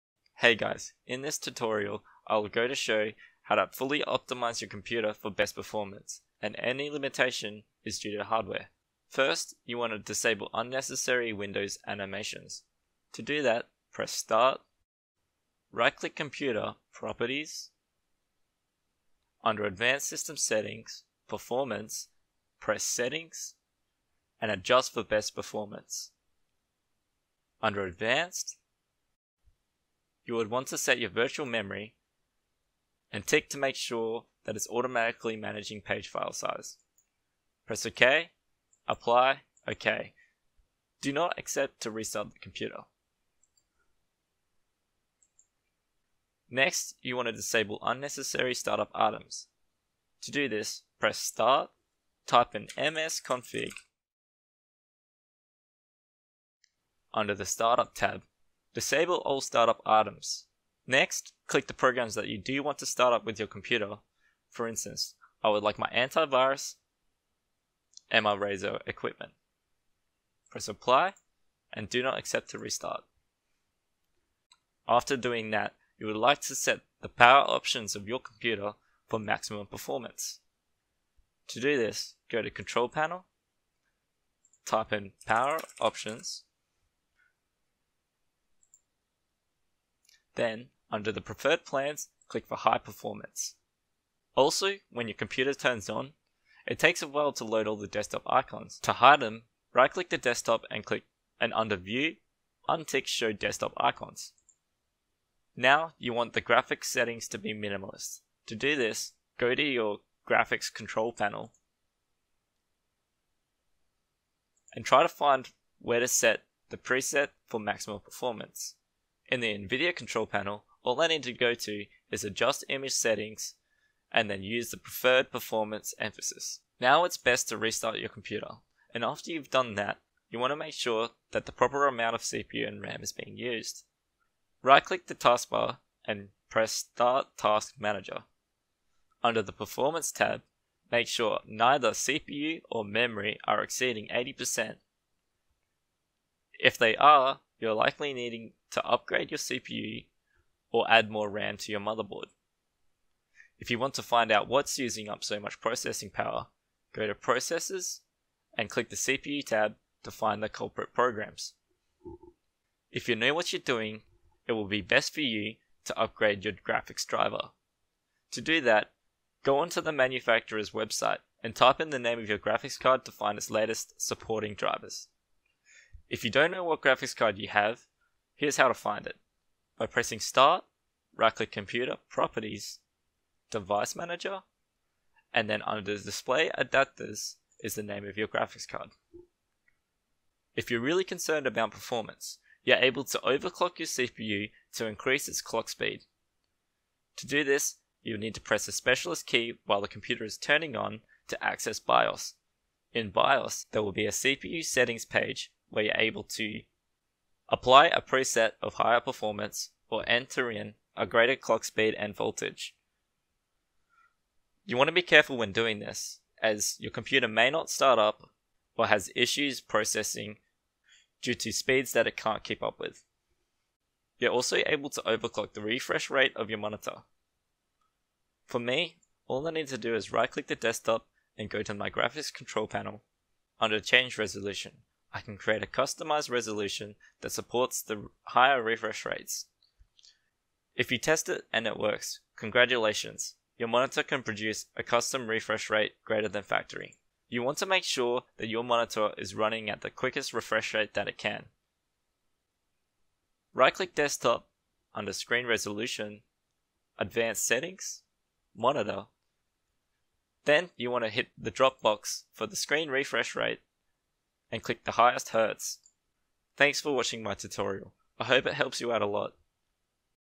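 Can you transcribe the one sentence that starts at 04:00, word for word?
If you test it and it works, congratulations, your monitor can produce a custom refresh rate greater than factory.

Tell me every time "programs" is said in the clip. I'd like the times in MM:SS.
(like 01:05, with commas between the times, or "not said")
01:01, 02:40.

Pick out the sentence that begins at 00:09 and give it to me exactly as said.
First, you want to disable unnecessary Windows animations.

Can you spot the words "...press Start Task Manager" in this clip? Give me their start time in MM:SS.
02:16.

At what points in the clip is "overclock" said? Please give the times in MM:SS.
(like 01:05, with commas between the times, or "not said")
03:13, 03:45.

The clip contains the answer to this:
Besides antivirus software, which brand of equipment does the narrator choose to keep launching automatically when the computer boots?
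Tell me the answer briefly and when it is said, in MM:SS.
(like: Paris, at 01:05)
Razer, at 01:08.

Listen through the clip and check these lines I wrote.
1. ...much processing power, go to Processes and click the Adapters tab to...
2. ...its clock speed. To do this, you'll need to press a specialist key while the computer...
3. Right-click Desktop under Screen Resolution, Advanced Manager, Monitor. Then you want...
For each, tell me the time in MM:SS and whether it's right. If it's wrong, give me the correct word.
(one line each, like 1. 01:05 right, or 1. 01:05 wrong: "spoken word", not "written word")
1. 02:35 wrong: "CPU", not "Adapters"
2. 03:15 right
3. 04:13 wrong: "Settings", not "Manager".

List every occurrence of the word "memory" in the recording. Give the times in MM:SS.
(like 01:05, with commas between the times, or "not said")
00:31, 02:22.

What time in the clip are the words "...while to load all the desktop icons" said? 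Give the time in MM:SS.
01:37.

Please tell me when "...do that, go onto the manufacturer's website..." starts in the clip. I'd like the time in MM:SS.
02:48.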